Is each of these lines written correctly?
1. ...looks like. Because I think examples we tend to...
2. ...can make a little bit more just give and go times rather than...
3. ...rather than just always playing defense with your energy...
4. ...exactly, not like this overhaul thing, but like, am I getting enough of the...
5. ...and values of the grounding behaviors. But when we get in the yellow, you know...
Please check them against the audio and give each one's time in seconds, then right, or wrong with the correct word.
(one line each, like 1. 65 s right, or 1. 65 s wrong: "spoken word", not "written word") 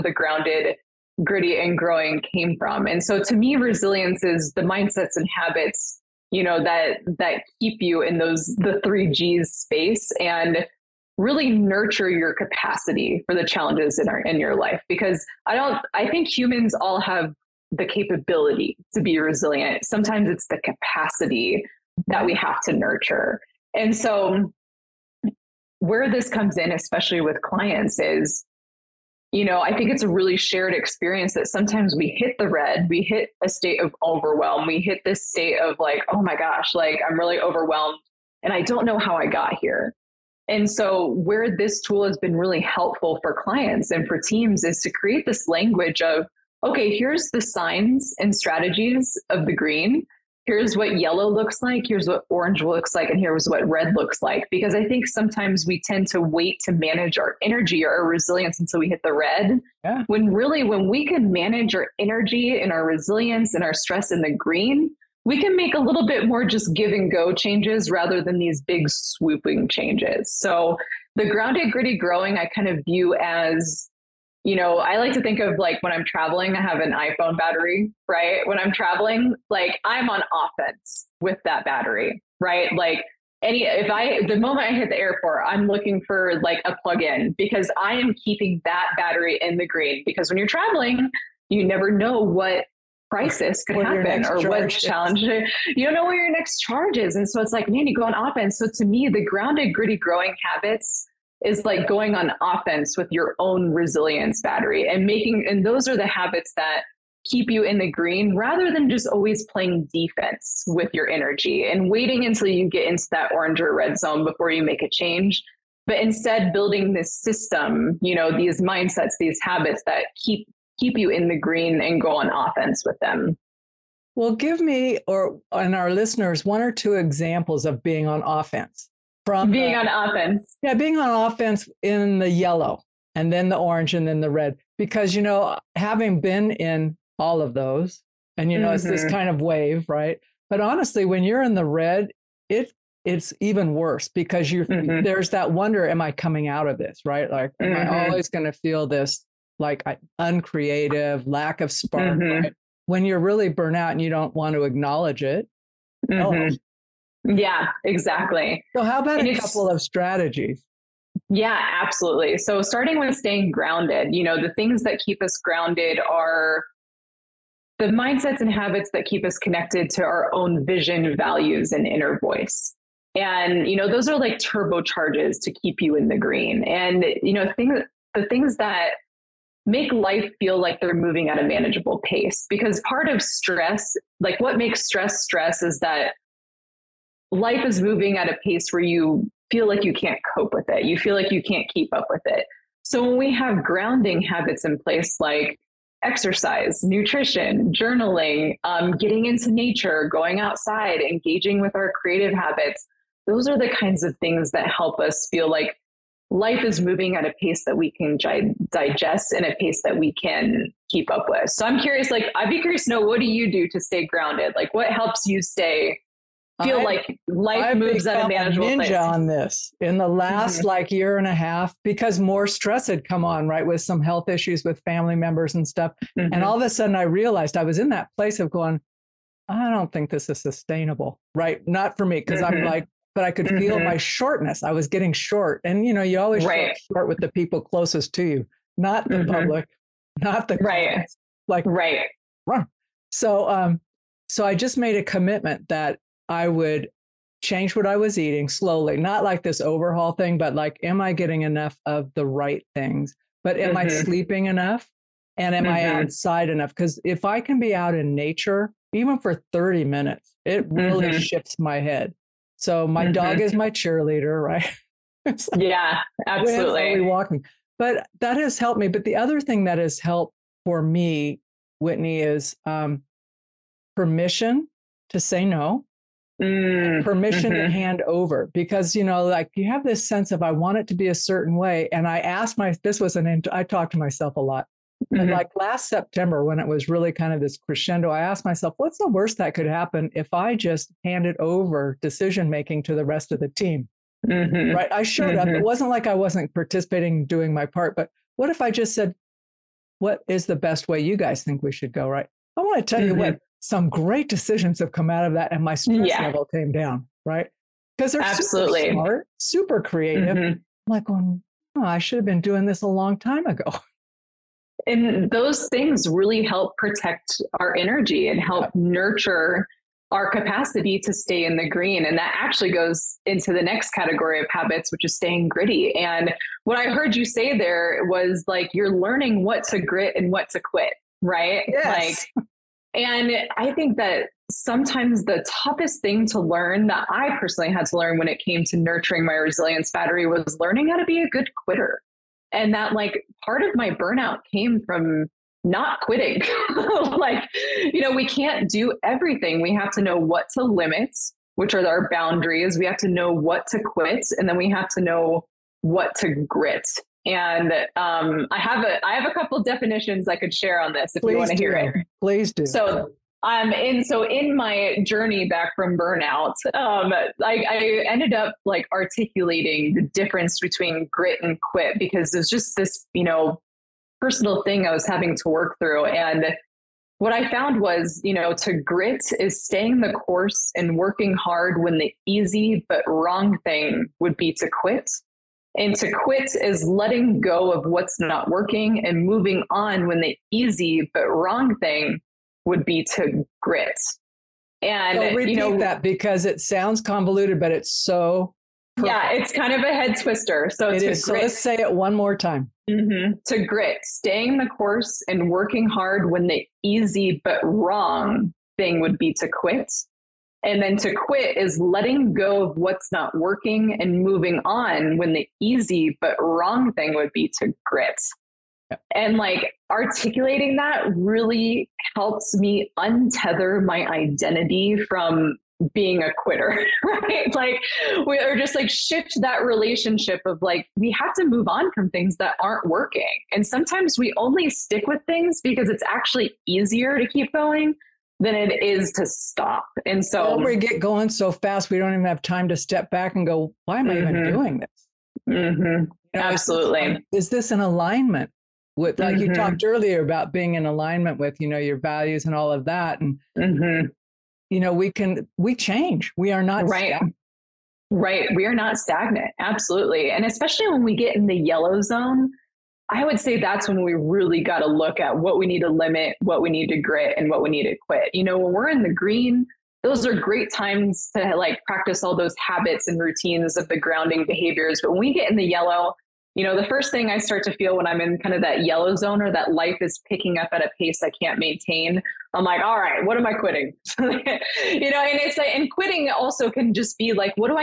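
1. 53 s wrong: "sometimes", not "examples"
2. 65 s wrong: "changes", not "times"
3. 108 s right
4. 248 s wrong: "slowly", not "exactly"
5. 473 s wrong: "routines", not "values".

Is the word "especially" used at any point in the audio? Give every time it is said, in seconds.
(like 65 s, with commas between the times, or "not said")
26 s, 460 s.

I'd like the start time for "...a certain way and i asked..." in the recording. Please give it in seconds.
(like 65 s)
281 s.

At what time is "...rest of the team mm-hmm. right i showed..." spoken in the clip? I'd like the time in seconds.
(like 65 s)
293 s.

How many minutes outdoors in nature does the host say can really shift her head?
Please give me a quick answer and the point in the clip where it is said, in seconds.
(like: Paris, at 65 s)
30, at 259 s.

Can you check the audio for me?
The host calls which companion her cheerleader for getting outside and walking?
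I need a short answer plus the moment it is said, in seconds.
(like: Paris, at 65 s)
my dog, at 262 s.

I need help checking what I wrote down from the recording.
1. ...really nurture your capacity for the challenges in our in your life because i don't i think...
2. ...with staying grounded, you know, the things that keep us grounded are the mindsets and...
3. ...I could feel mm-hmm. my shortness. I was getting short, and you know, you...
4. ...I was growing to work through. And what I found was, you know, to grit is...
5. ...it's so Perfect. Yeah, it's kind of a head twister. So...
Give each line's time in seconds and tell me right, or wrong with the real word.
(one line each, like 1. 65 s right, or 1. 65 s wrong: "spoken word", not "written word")
1. 11 s right
2. 162 s right
3. 233 s right
4. 374 s wrong: "having", not "growing"
5. 397 s right.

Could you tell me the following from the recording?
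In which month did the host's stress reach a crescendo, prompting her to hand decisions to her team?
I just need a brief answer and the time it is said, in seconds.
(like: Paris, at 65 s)
September, at 285 s.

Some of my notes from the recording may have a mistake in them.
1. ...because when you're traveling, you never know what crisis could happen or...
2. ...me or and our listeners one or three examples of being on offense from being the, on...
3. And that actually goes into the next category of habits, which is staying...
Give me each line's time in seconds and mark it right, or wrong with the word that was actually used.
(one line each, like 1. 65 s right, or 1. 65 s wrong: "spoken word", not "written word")
1. 90 s right
2. 124 s wrong: "two", not "three"
3. 322 s right.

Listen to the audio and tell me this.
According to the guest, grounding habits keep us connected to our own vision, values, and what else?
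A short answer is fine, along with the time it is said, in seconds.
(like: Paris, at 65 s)
inner voice, at 171 s.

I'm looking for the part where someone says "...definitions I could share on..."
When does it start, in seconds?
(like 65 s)
359 s.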